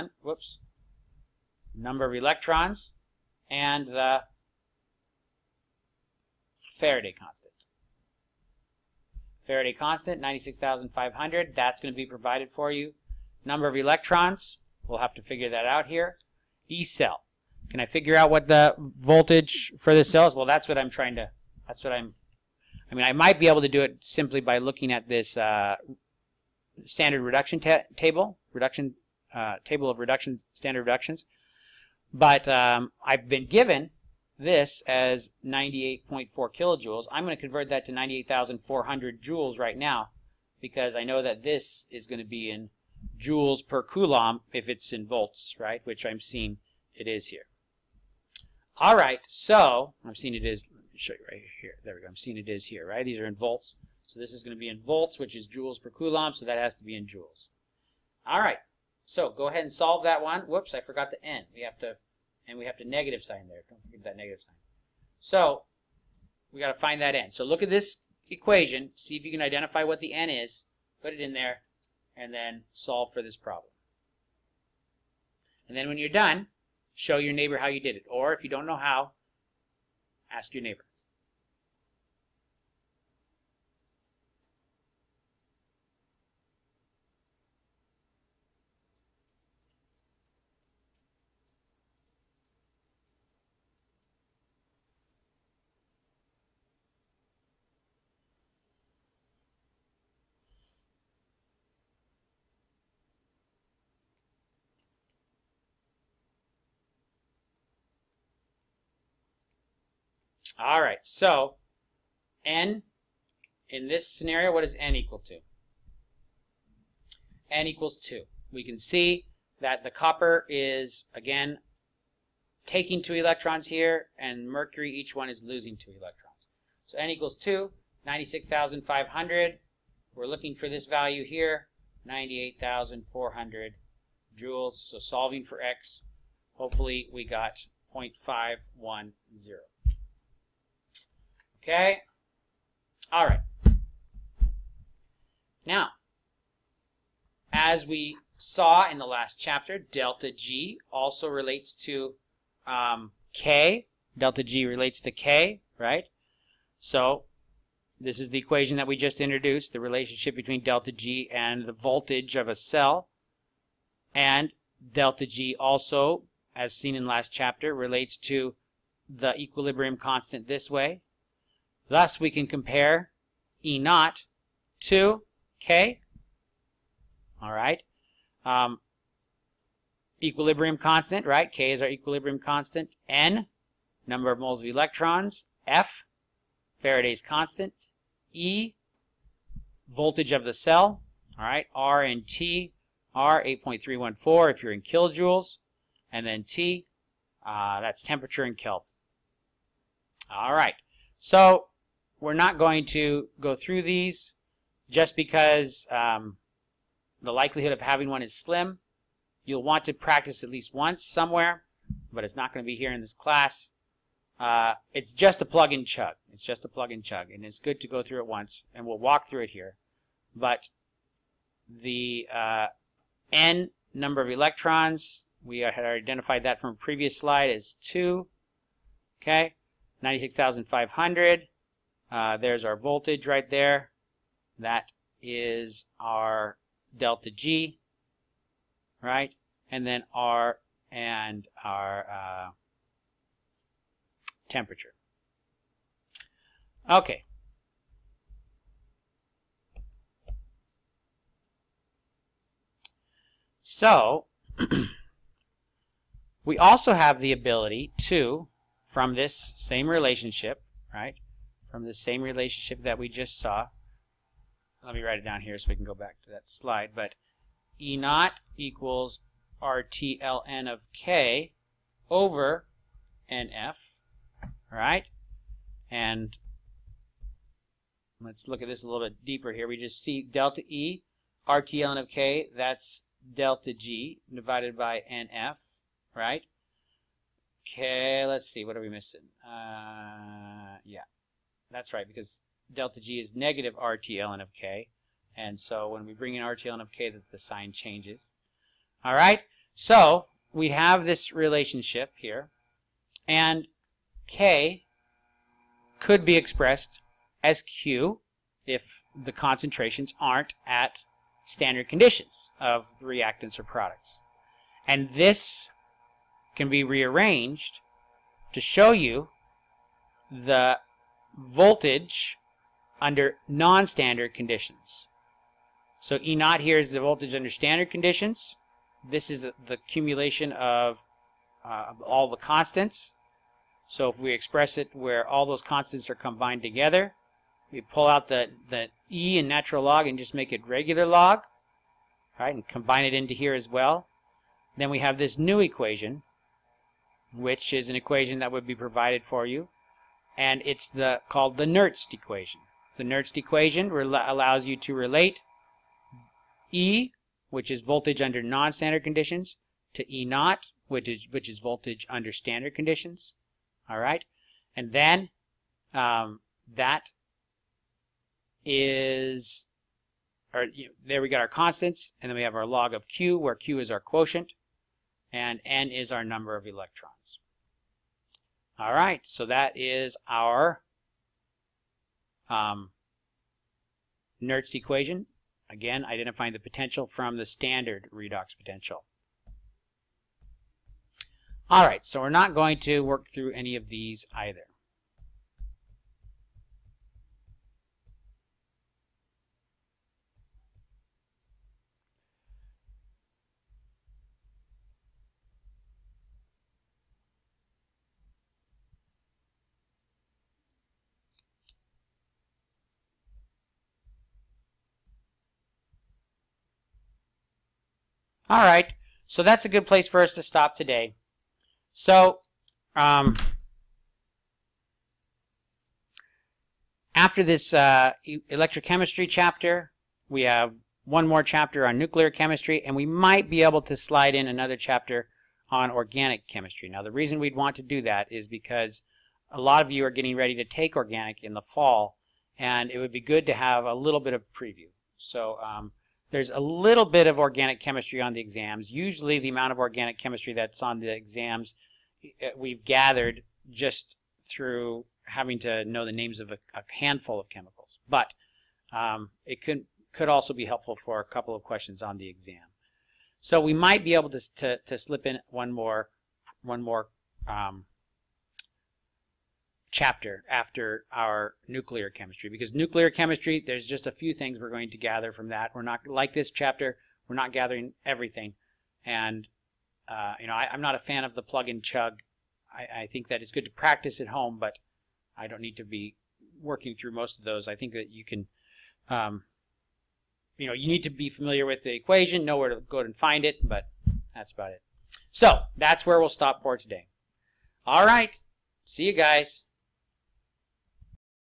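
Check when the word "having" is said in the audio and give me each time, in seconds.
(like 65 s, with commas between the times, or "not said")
207 s, 455 s.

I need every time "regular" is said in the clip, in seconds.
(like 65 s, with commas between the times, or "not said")
340 s.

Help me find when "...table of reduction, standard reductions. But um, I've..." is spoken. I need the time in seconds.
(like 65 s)
29 s.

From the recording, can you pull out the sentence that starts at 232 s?
Uh, there's our voltage right there.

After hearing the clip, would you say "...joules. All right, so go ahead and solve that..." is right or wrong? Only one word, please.
right.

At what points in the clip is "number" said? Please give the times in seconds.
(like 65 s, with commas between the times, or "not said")
1 s, 13 s, 184 s, 223 s, 376 s.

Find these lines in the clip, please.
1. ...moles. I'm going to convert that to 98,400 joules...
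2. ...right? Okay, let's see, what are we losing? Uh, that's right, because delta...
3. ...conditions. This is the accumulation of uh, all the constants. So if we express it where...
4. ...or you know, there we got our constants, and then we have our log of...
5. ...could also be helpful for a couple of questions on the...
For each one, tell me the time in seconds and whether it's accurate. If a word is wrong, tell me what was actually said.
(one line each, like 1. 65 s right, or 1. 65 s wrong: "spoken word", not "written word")
1. 36 s wrong: "kilojoules", not "moles"
2. 286 s wrong: "missing", not "losing"
3. 327 s right
4. 370 s right
5. 460 s right.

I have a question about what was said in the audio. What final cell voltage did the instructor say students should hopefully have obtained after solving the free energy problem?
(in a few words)
0.510.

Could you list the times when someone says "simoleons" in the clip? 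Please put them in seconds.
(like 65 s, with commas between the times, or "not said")
not said.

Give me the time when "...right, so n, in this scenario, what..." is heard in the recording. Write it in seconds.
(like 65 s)
110 s.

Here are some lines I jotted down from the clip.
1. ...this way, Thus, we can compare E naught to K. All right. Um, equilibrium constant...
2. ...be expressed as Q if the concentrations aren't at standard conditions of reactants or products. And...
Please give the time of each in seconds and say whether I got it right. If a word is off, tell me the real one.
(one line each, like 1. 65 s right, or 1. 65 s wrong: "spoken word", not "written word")
1. 170 s right
2. 306 s right.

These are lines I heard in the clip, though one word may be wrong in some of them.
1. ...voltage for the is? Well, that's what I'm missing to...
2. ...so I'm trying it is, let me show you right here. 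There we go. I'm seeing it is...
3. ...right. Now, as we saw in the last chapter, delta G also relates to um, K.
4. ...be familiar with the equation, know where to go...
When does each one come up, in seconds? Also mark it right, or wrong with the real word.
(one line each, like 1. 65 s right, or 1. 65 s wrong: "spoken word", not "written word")
1. 18 s wrong: "trying", not "missing"
2. 49 s wrong: "seeing", not "trying"
3. 143 s right
4. 491 s right.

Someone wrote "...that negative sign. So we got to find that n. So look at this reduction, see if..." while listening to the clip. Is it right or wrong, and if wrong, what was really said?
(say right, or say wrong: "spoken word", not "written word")
wrong: "equation", not "reduction".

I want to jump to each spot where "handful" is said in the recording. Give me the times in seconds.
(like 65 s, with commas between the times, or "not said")
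456 s.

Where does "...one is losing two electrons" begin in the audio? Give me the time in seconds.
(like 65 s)
125 s.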